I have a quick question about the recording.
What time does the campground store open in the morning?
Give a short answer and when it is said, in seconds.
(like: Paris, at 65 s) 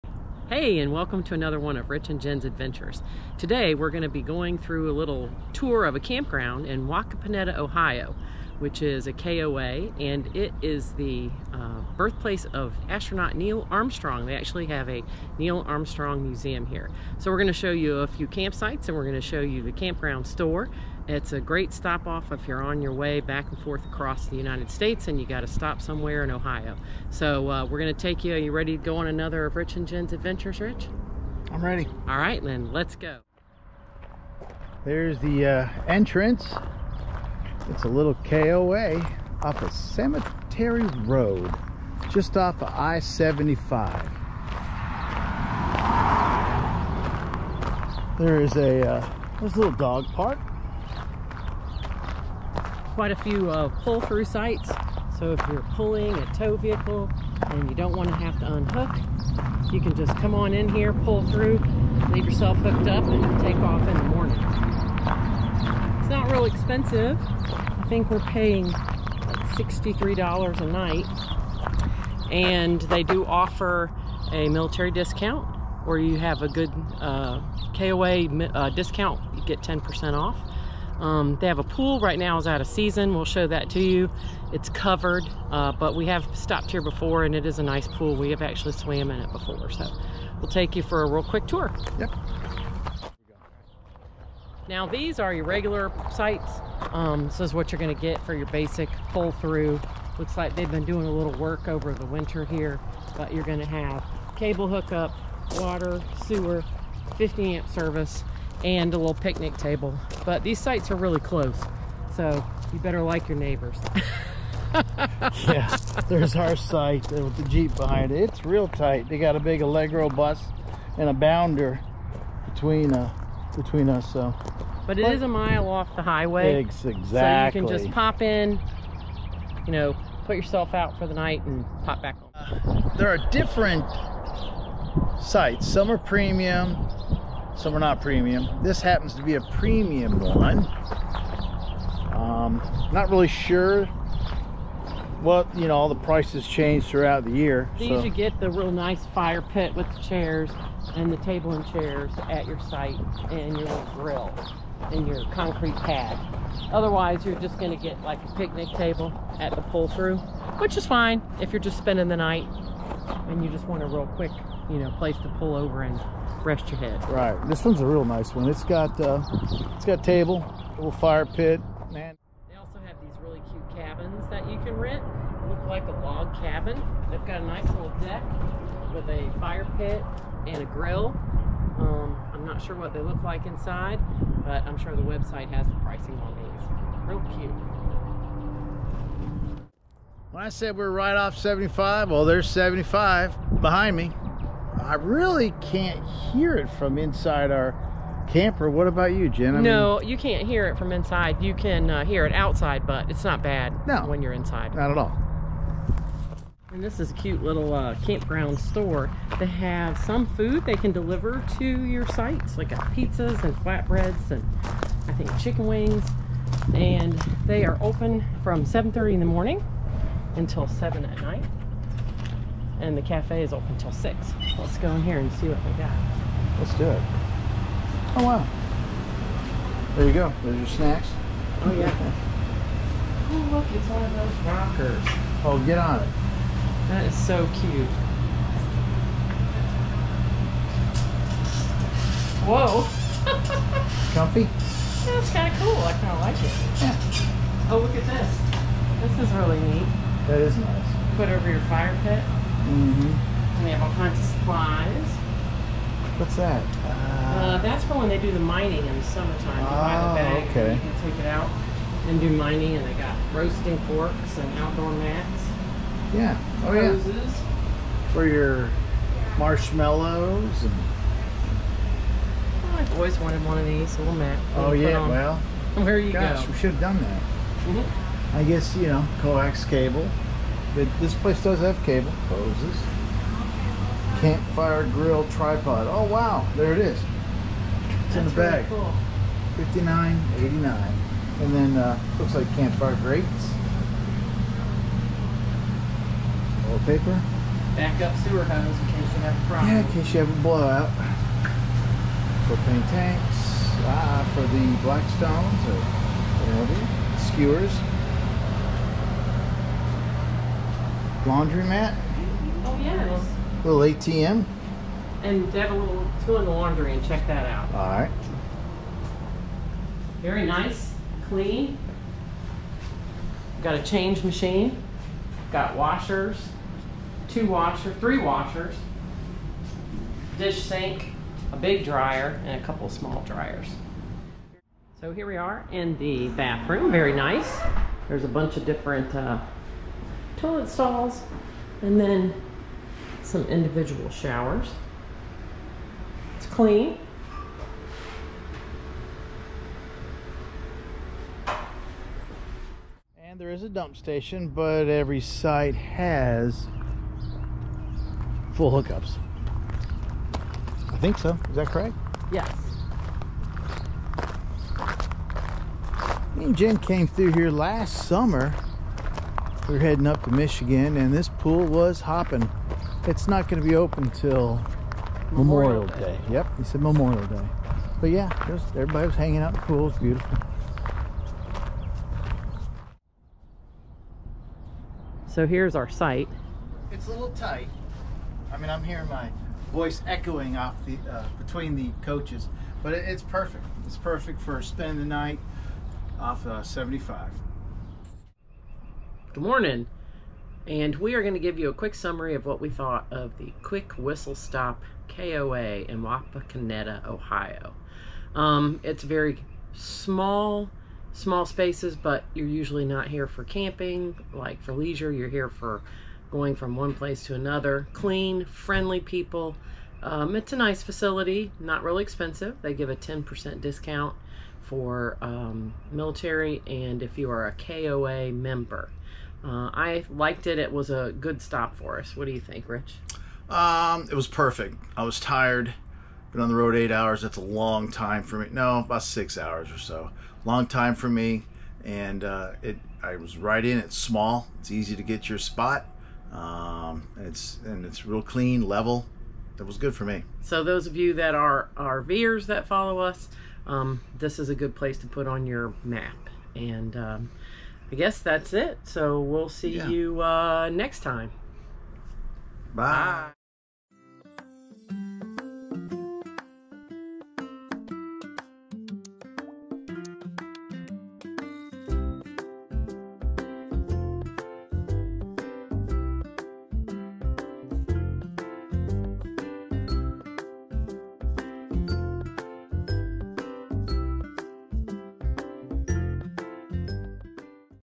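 7:30, at 218 s.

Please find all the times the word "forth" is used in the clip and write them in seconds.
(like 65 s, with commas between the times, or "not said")
23 s.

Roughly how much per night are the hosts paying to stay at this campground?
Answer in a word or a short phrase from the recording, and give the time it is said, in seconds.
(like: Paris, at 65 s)
$63, at 69 s.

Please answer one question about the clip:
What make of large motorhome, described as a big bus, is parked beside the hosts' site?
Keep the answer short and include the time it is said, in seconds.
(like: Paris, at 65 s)
Allegro, at 119 s.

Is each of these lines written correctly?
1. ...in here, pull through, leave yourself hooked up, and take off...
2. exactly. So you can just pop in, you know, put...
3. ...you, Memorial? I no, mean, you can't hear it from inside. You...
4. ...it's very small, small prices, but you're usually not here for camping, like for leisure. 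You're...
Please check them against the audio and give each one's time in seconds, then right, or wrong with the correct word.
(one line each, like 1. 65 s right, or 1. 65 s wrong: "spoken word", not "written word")
1. 60 s right
2. 126 s right
3. 199 s wrong: "Jen", not "Memorial"
4. 408 s wrong: "spaces", not "prices".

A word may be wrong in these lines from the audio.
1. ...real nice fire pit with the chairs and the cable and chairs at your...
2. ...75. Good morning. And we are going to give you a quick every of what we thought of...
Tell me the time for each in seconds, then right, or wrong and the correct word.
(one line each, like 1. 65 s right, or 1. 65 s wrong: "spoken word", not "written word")
1. 148 s wrong: "table", not "cable"
2. 396 s wrong: "summary", not "every".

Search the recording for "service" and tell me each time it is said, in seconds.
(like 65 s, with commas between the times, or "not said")
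107 s.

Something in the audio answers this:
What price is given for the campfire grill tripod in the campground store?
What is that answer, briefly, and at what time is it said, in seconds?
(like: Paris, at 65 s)
59.89, at 289 s.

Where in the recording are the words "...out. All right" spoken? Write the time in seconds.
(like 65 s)
317 s.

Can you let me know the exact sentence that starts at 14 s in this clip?
They actually have a Neil Armstrong Museum here.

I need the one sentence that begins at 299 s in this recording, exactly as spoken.
Yeah, in case you have a blowout.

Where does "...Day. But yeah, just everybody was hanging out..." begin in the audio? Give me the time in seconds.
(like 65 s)
377 s.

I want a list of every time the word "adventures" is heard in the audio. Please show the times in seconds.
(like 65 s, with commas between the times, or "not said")
2 s, 30 s.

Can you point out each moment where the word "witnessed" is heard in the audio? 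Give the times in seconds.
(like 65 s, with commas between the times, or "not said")
not said.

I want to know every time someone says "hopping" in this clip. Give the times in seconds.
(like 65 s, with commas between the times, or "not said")
372 s.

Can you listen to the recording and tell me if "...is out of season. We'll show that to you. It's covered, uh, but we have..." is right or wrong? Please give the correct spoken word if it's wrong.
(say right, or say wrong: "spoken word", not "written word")
right.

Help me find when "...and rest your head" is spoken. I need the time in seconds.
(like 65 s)
165 s.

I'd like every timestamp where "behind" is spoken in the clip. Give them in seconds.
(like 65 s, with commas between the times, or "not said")
117 s, 193 s.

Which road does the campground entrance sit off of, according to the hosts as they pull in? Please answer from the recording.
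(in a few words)
Cemetery Road.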